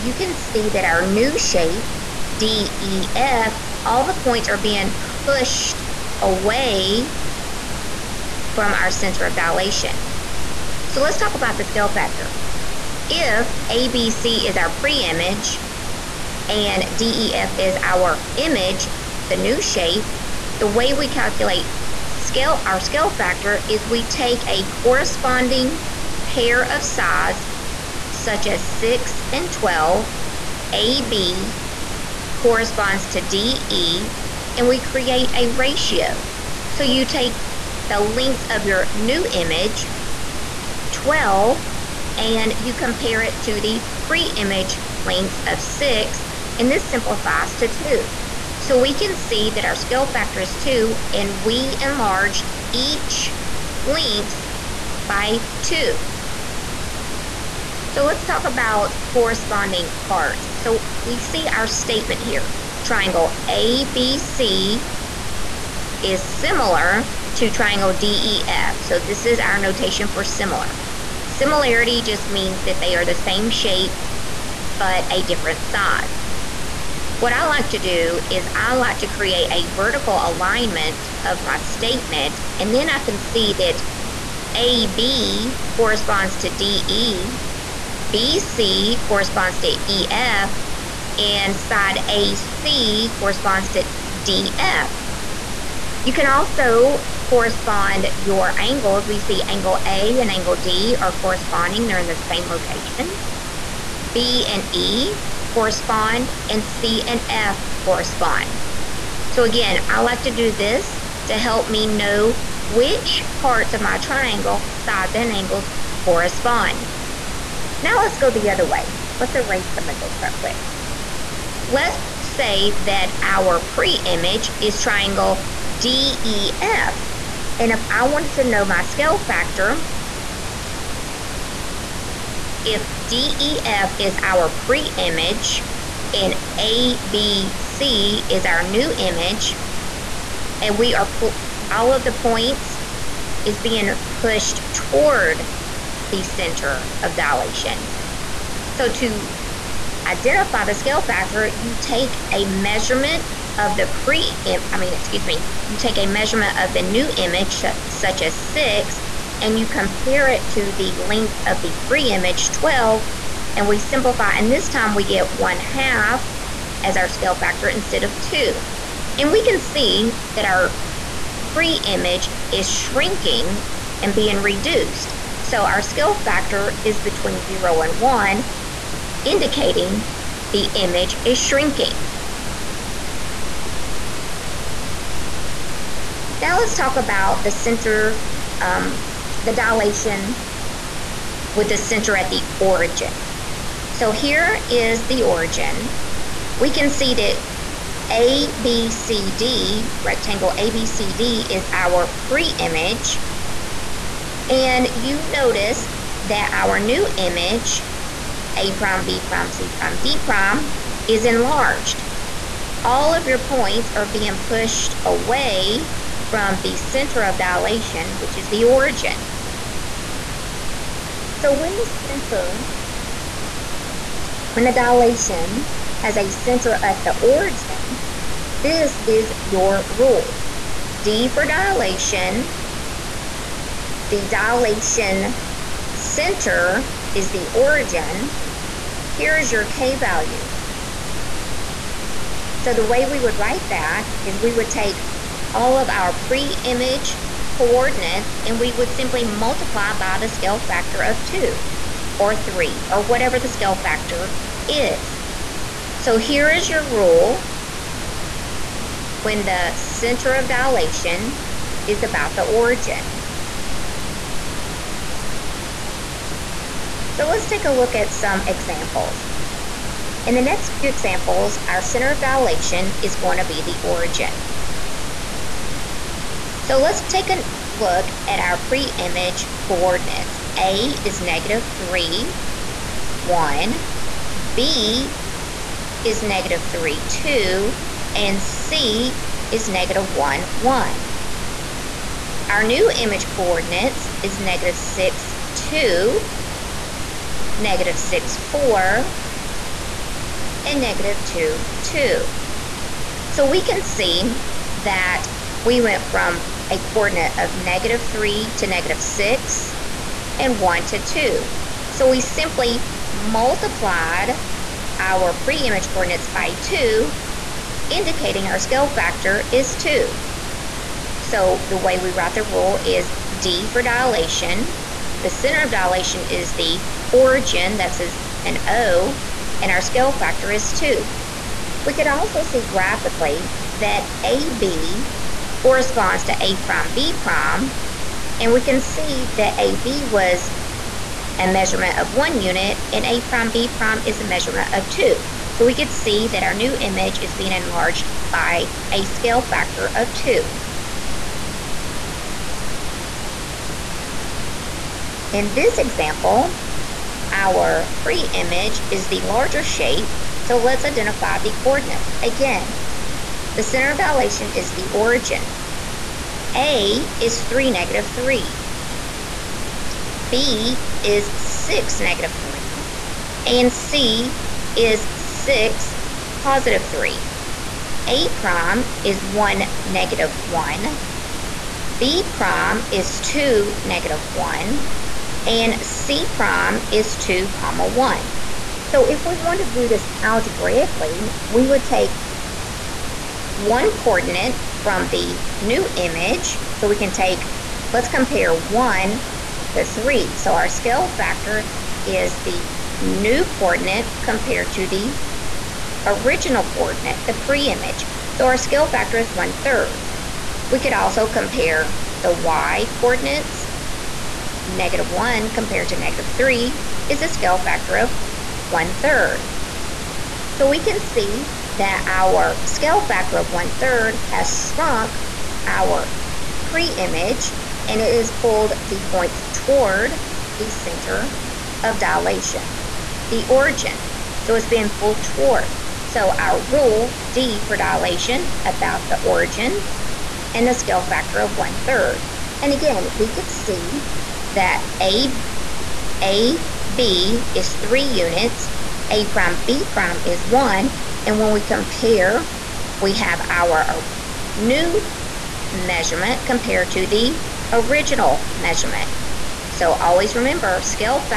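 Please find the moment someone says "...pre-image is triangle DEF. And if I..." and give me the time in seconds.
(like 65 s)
123 s.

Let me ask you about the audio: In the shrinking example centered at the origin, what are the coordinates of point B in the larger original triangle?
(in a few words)
(6, -3).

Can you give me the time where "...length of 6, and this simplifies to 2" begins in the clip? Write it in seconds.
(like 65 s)
45 s.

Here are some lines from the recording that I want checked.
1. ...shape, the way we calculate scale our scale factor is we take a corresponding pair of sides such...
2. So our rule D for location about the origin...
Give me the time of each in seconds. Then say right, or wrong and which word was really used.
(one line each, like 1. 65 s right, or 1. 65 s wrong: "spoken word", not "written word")
1. 19 s right
2. 436 s wrong: "dilation", not "location".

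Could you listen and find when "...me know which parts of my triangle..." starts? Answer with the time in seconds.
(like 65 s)
111 s.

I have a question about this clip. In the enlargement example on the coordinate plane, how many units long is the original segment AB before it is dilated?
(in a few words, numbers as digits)
1.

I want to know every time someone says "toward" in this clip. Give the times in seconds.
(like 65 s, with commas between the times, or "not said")
144 s, 429 s, 435 s.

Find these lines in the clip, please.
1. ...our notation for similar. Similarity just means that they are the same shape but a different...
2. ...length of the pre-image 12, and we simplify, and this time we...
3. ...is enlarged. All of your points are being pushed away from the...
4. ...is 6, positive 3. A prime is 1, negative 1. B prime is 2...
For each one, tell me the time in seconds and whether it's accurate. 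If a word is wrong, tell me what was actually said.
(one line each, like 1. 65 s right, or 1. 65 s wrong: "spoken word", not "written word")
1. 69 s right
2. 160 s right
3. 211 s right
4. 374 s right.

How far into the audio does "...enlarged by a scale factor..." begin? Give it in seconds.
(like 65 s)
347 s.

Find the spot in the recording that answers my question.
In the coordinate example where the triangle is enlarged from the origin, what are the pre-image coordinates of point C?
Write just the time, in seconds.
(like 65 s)
289 s.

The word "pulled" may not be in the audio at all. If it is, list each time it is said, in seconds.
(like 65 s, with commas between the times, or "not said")
428 s, 434 s.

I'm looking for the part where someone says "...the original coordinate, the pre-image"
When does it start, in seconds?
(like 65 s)
404 s.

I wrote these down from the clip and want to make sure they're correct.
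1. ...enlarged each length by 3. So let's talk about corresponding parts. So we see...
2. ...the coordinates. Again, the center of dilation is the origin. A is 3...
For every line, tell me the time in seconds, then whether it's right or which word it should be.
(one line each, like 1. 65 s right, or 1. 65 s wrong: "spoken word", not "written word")
1. 51 s wrong: "2", not "3"
2. 361 s right.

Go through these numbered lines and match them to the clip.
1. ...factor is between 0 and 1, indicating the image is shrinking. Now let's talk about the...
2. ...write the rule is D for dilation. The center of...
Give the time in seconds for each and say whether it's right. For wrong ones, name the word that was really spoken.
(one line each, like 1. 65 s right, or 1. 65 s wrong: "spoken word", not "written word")
1. 176 s right
2. 322 s right.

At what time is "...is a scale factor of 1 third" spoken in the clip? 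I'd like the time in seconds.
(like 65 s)
417 s.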